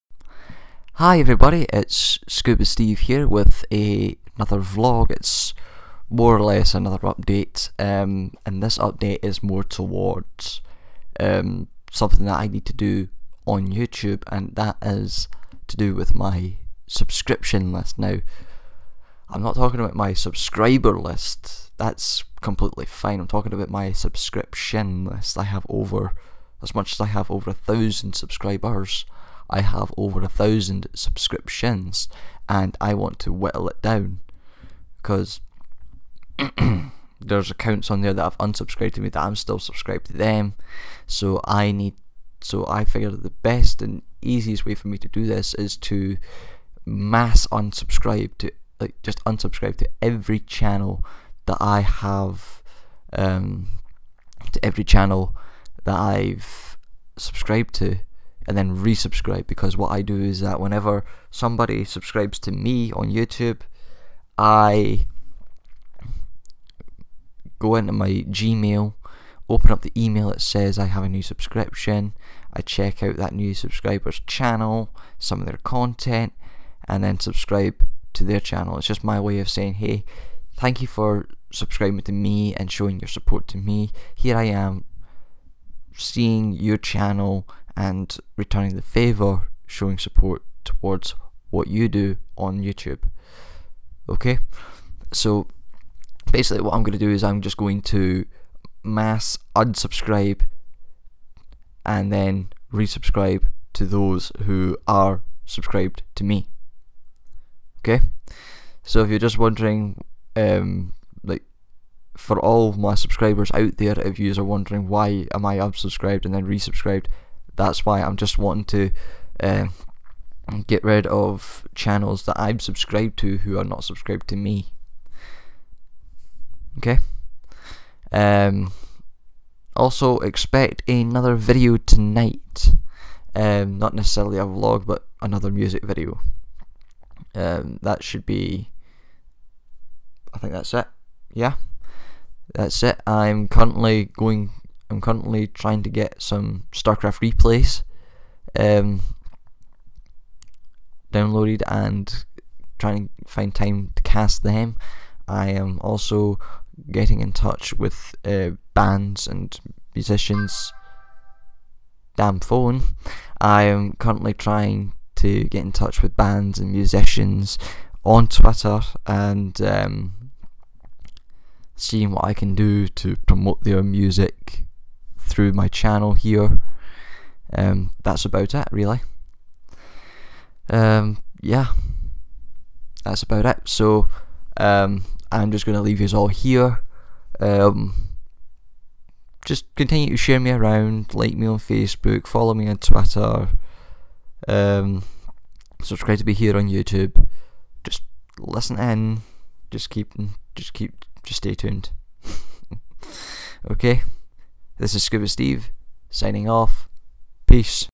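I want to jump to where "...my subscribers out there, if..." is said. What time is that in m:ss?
1:52.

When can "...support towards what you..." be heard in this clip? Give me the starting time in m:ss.
1:29.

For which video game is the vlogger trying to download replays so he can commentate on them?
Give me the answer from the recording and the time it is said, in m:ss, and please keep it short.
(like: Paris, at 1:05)
StarCraft, at 2:26.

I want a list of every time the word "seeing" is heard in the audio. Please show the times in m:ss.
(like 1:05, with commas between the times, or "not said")
1:25, 2:51.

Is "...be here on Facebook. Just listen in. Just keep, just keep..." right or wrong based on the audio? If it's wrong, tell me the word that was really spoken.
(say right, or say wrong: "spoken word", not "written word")
wrong: "YouTube", not "Facebook".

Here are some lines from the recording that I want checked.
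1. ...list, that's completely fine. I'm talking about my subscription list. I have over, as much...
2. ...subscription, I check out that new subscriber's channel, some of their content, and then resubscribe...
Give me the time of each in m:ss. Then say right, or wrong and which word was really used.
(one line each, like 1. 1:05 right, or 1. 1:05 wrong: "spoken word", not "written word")
1. 0:20 right
2. 1:11 wrong: "subscribe", not "resubscribe".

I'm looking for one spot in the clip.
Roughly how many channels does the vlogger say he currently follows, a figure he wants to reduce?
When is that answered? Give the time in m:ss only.
0:29.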